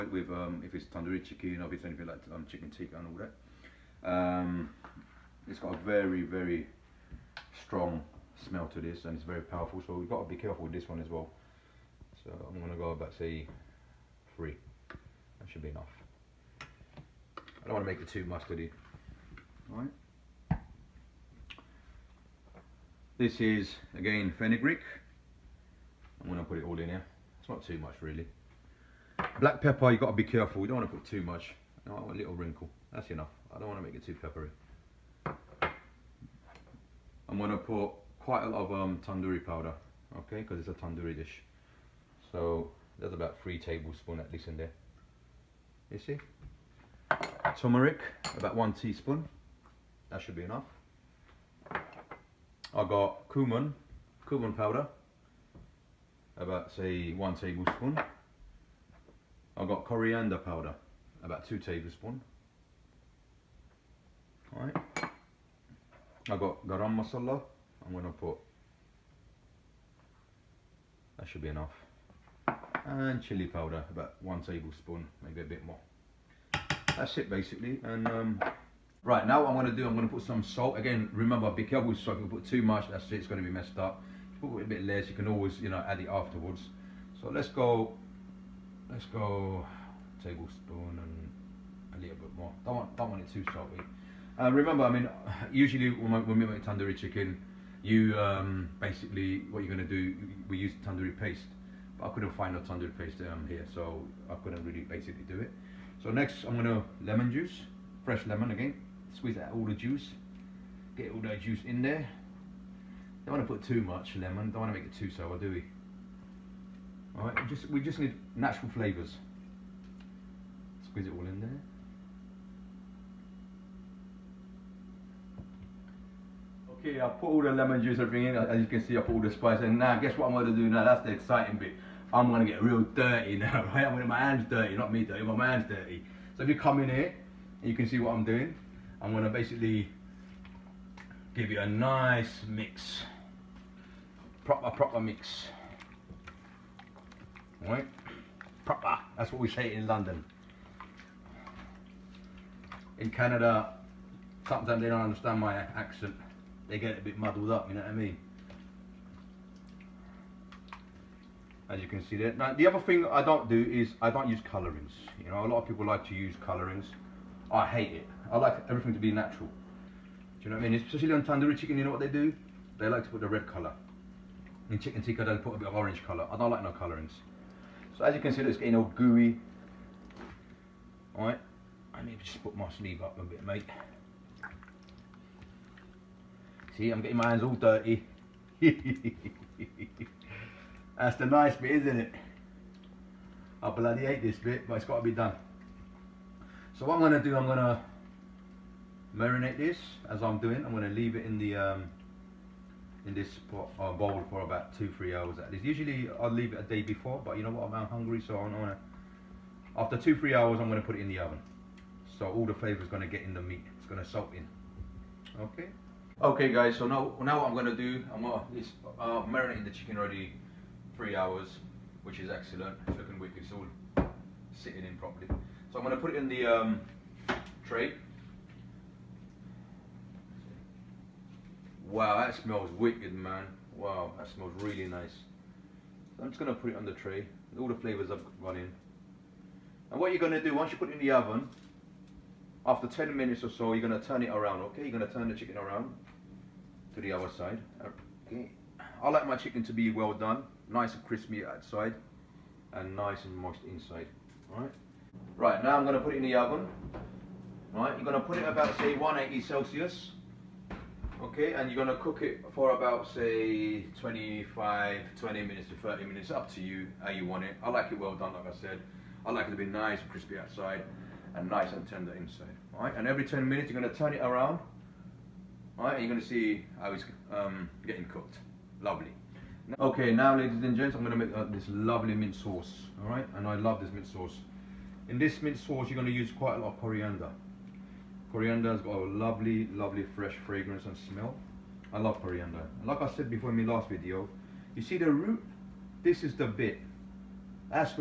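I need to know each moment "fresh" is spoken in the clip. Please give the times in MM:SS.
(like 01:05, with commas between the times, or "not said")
01:48, 04:50.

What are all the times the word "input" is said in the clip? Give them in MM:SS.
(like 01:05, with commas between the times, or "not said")
not said.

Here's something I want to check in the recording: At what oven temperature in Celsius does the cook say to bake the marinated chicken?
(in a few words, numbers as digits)
180.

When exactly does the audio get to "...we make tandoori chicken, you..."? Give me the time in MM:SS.
01:36.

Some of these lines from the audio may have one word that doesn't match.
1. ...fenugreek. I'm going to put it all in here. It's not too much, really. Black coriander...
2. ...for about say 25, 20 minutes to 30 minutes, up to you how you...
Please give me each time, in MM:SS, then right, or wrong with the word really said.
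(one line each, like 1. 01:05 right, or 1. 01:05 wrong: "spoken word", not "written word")
1. 00:24 wrong: "pepper", not "coriander"
2. 04:22 right.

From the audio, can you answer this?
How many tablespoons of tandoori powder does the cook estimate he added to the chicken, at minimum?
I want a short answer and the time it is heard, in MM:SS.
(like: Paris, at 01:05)
3 tablespoons, at 00:43.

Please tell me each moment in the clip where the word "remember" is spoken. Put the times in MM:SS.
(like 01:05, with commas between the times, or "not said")
01:21, 01:34.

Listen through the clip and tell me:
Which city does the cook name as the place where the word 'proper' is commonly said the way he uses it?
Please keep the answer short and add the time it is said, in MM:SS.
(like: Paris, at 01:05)
London, at 02:29.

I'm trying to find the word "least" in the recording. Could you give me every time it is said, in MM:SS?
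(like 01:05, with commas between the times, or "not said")
00:44, 03:25.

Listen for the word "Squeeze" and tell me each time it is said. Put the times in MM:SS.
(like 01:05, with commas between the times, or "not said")
01:49, 02:00.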